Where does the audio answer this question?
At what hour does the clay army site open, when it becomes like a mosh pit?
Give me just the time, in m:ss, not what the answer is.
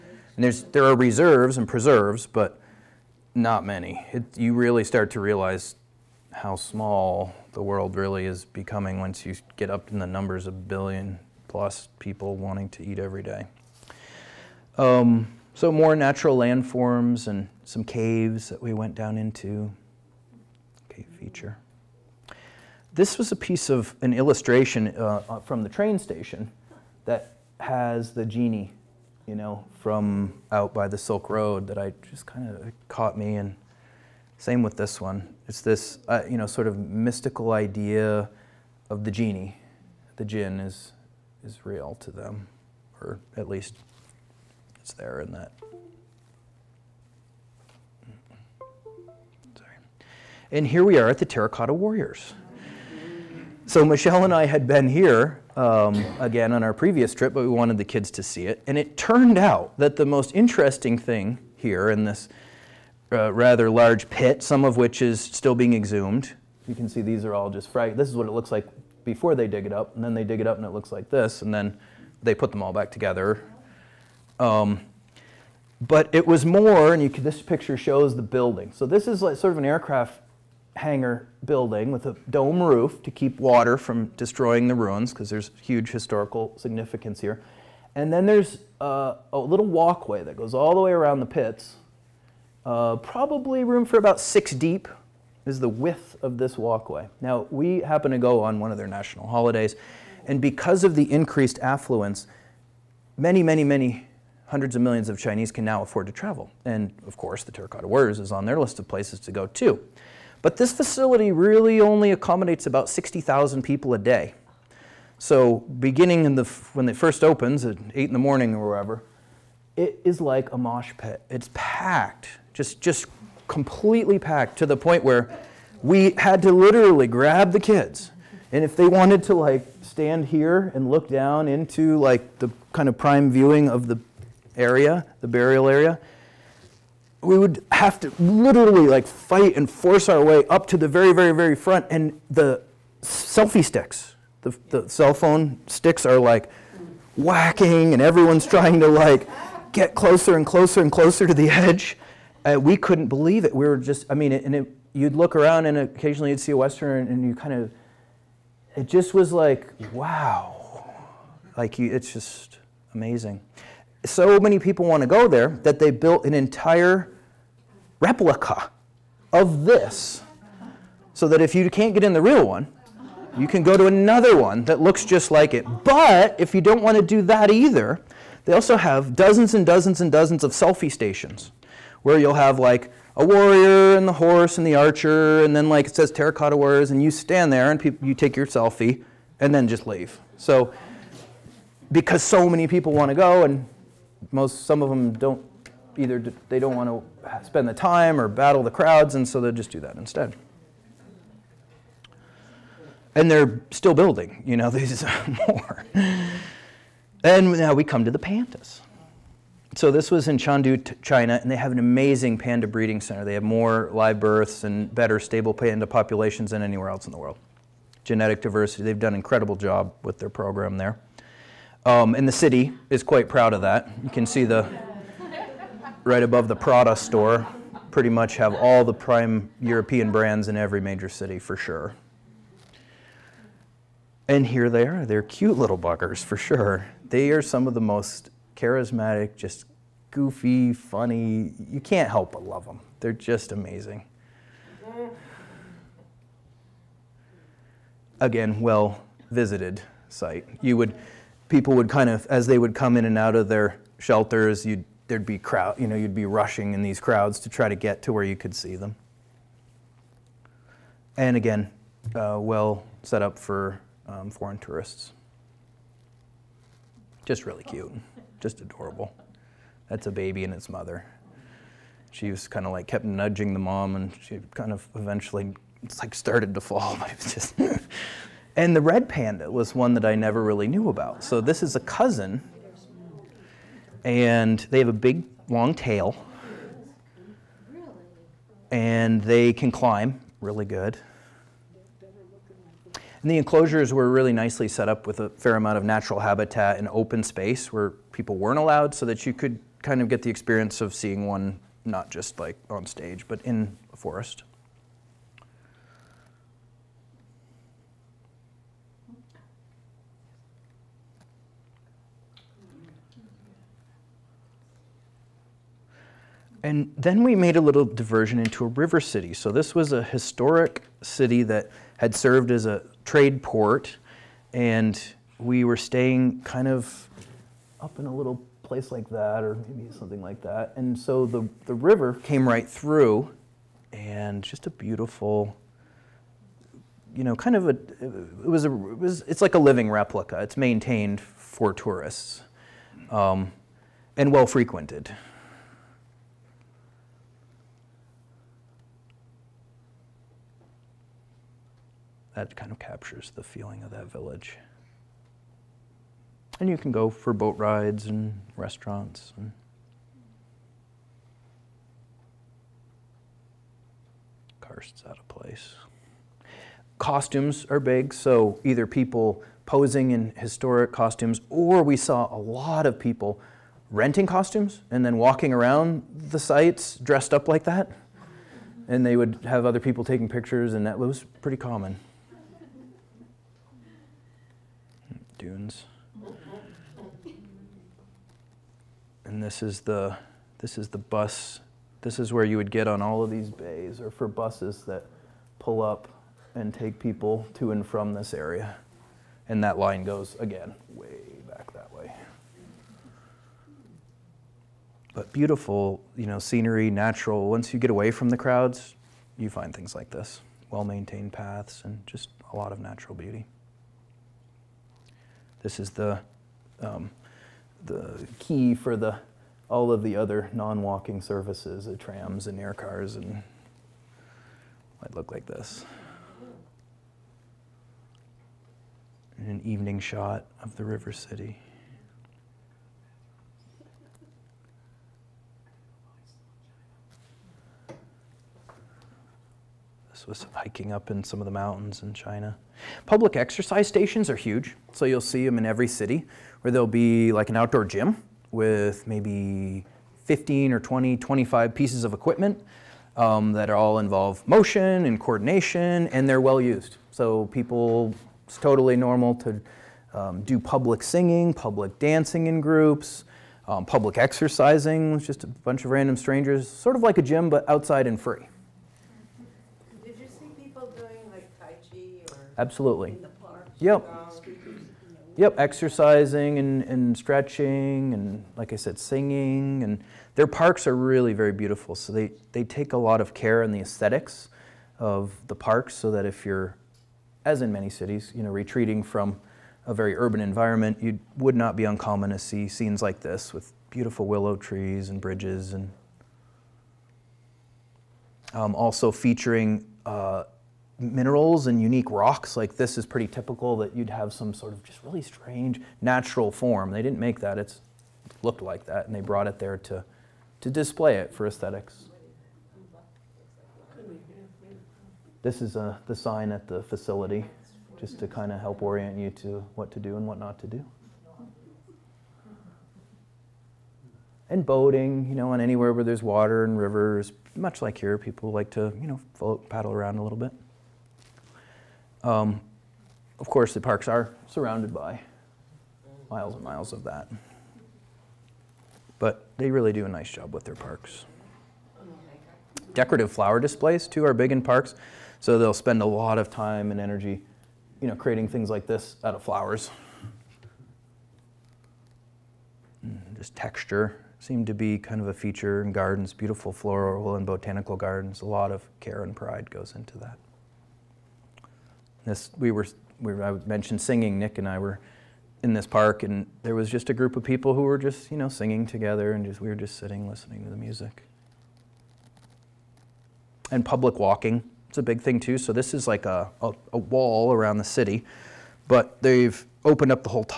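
1:57.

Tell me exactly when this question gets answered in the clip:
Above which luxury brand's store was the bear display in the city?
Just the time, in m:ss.
3:46.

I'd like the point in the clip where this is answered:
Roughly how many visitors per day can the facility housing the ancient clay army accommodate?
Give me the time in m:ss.
1:52.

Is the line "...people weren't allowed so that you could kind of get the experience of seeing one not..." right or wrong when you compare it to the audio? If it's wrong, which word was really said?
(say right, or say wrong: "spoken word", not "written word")
right.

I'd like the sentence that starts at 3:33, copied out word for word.
They have more live births and better stable panda populations than anywhere else in the world.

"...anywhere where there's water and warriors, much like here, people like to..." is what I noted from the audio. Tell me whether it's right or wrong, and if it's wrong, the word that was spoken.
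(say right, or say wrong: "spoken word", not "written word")
wrong: "rivers", not "warriors".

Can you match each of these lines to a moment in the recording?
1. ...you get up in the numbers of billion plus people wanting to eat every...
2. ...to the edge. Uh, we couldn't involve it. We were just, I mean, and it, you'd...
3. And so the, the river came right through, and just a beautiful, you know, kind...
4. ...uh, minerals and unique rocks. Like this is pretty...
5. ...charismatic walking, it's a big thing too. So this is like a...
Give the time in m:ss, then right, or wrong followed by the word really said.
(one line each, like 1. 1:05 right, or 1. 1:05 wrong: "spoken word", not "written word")
1. 0:09 right
2. 2:31 wrong: "believe", not "involve"
3. 5:30 right
4. 8:20 right
5. 9:33 wrong: "public", not "charismatic".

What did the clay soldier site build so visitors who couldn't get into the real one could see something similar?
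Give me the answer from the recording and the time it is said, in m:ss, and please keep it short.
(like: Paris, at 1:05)
an entire replica, at 2:46.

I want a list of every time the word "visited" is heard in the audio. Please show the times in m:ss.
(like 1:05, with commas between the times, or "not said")
4:09.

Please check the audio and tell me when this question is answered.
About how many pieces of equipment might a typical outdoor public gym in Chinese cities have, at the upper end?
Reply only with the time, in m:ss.
7:31.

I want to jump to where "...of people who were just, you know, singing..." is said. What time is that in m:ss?
9:27.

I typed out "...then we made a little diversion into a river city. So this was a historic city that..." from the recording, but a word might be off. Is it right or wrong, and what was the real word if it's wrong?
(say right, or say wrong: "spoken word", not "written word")
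right.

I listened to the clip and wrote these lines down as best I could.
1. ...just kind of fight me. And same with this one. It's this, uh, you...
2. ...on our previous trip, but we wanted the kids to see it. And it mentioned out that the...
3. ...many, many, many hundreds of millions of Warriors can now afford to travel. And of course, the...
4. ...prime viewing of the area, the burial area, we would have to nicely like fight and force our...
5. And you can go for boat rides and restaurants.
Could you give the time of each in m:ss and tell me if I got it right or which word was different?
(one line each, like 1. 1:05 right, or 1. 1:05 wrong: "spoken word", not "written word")
1. 0:32 wrong: "caught", not "fight"
2. 0:56 wrong: "turned", not "mentioned"
3. 1:43 wrong: "Chinese", not "Warriors"
4. 2:12 wrong: "literally", not "nicely"
5. 5:56 right.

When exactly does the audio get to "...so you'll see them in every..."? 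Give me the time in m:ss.
7:24.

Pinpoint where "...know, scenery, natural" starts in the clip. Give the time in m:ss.
6:46.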